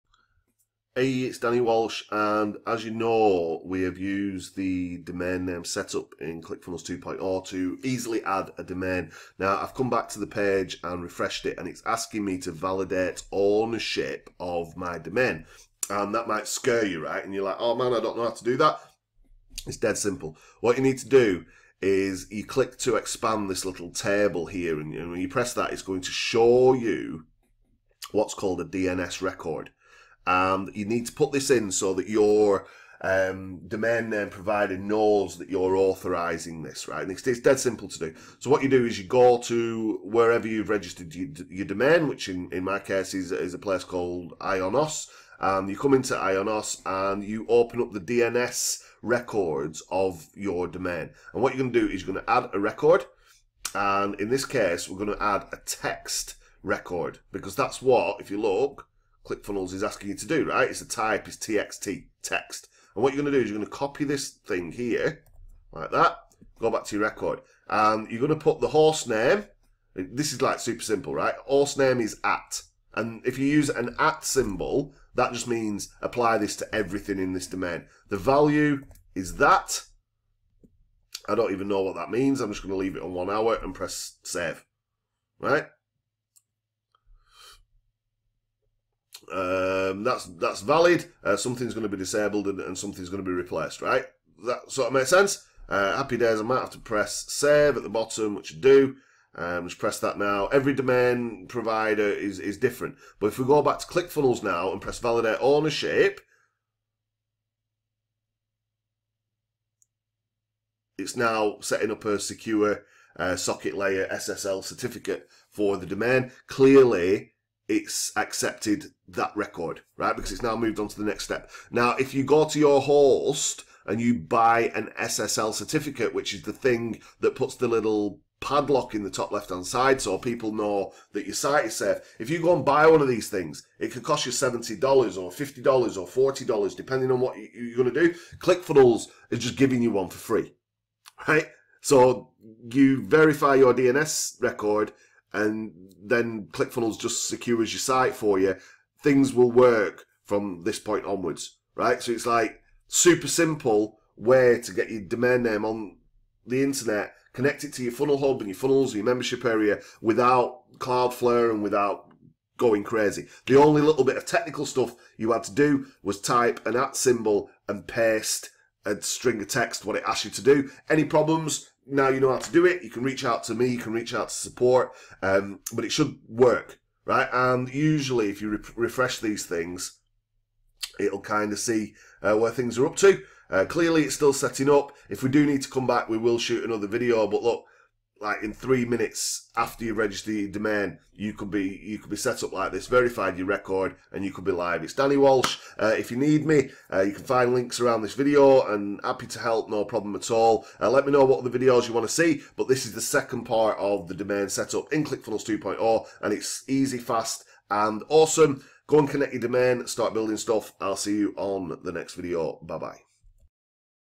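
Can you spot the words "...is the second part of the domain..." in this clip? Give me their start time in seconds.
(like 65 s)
202 s.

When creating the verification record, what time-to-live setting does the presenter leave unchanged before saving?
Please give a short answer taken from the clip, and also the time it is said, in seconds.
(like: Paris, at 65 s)
1 hour, at 83 s.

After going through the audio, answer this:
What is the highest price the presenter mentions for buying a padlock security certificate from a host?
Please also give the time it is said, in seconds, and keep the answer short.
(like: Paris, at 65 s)
$70, at 134 s.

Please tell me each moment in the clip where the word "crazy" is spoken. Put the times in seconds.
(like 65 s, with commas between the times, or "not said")
162 s.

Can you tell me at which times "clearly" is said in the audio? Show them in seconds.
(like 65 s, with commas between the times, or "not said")
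116 s, 183 s.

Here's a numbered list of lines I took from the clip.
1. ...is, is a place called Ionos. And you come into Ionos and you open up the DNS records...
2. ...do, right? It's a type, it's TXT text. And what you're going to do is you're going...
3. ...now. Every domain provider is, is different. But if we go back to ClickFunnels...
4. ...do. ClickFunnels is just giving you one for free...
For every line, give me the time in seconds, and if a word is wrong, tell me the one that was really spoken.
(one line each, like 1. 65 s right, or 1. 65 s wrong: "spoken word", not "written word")
1. 43 s right
2. 60 s right
3. 100 s right
4. 138 s right.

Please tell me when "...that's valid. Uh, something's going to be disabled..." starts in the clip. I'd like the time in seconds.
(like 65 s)
90 s.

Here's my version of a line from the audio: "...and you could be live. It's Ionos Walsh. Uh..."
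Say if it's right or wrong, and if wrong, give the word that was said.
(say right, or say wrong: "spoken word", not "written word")
wrong: "Danny", not "Ionos".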